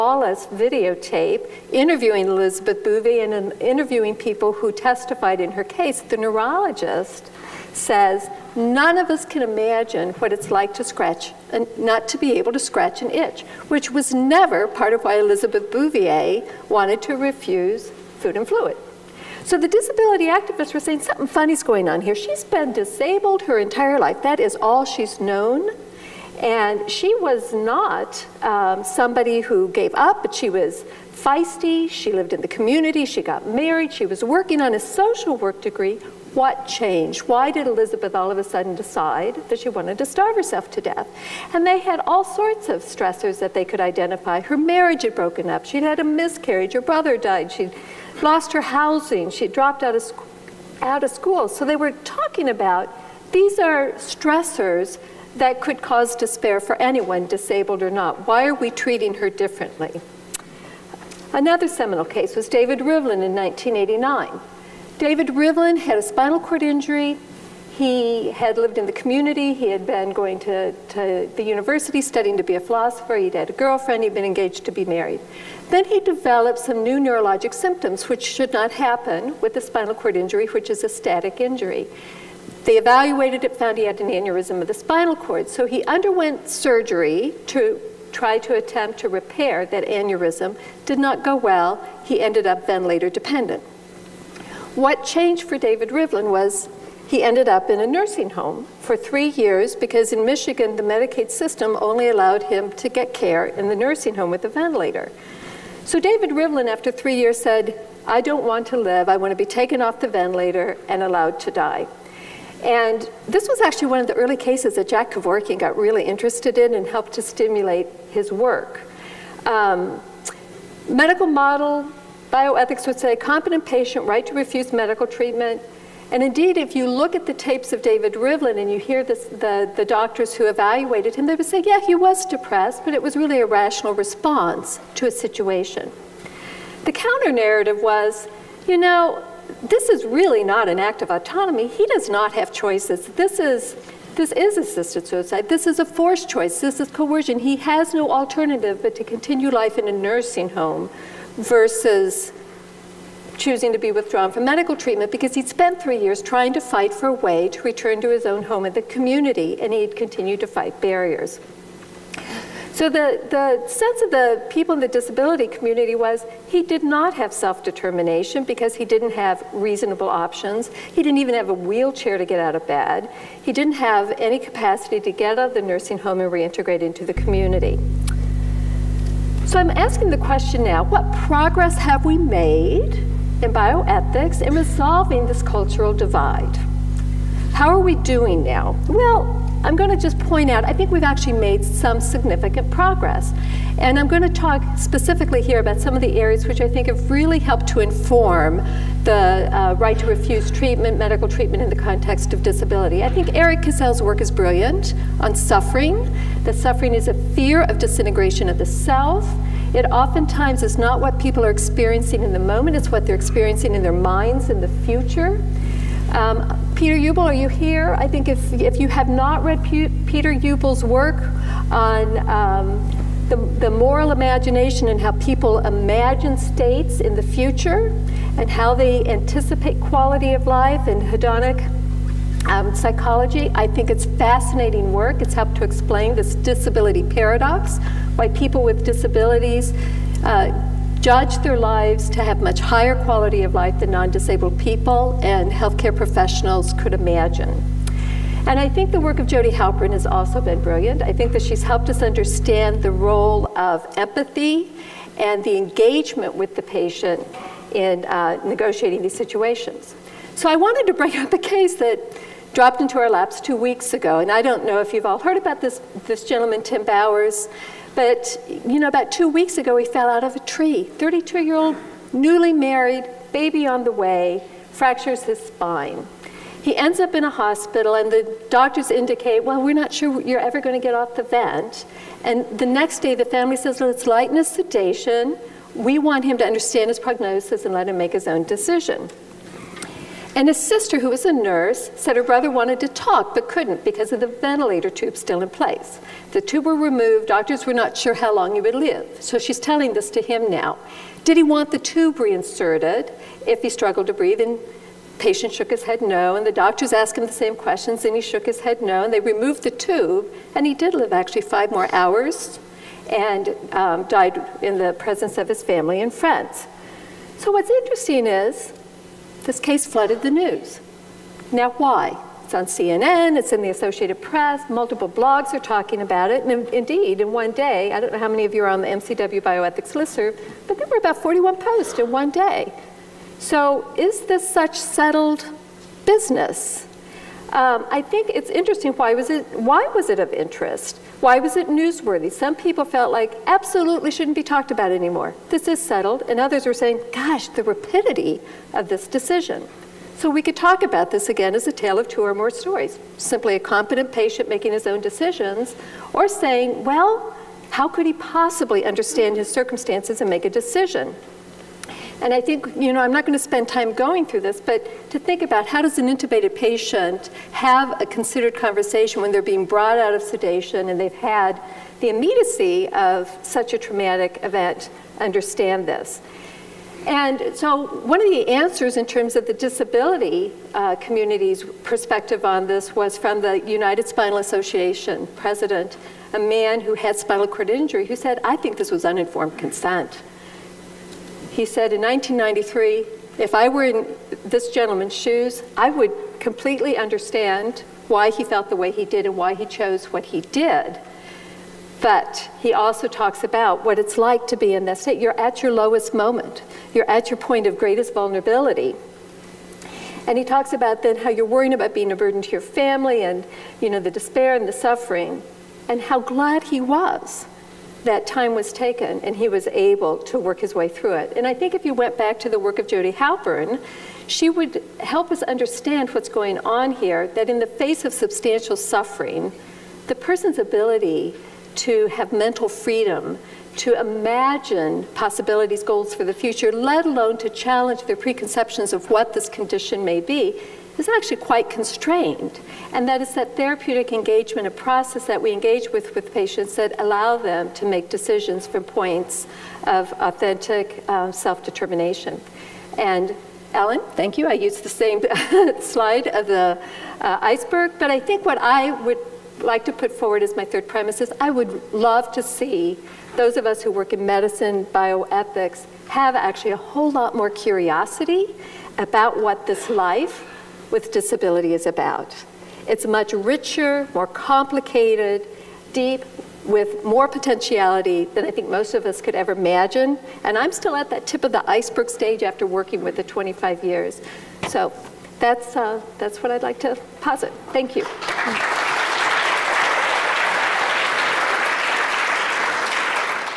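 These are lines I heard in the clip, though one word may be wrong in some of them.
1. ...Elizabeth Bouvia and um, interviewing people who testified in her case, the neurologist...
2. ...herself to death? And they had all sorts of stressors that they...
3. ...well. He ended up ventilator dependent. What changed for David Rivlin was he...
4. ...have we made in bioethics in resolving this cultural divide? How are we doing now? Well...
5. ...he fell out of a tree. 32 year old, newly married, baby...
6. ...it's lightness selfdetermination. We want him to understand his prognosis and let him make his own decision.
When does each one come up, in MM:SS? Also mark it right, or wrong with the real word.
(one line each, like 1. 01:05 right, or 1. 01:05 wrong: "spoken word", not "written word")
1. 00:02 right
2. 00:40 right
3. 01:31 right
4. 03:01 right
5. 04:29 right
6. 04:43 wrong: "sedation", not "selfdetermination".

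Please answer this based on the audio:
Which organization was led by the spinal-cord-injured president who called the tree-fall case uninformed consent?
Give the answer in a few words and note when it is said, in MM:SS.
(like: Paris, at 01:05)
United Spinal Association, at 06:23.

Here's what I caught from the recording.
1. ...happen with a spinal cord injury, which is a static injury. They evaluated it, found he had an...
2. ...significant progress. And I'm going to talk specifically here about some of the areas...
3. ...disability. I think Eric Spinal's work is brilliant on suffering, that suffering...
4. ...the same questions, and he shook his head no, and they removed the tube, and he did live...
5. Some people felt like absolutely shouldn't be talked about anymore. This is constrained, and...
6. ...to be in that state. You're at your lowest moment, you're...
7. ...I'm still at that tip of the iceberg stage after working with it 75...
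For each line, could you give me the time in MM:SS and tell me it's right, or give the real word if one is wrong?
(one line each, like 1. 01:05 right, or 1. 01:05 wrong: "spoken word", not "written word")
1. 01:18 right
2. 03:11 right
3. 03:22 wrong: "Cassell", not "Spinal"
4. 05:07 right
5. 05:42 wrong: "settled", not "constrained"
6. 06:44 right
7. 08:00 wrong: "25", not "75".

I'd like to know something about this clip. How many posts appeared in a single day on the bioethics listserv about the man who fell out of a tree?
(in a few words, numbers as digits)
41.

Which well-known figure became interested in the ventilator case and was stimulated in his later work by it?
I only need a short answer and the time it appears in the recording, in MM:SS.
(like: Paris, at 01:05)
Jack Kevorkian, at 01:54.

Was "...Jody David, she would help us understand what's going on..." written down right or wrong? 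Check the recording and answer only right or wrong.
wrong.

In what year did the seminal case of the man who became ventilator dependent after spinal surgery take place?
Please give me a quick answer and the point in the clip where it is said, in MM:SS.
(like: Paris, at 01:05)
1989, at 01:03.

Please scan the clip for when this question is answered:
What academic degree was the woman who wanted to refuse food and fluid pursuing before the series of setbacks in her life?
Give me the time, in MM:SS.
00:34.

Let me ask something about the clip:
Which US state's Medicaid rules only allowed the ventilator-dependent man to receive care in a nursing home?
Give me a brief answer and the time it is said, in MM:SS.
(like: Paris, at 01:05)
Michigan, at 01:40.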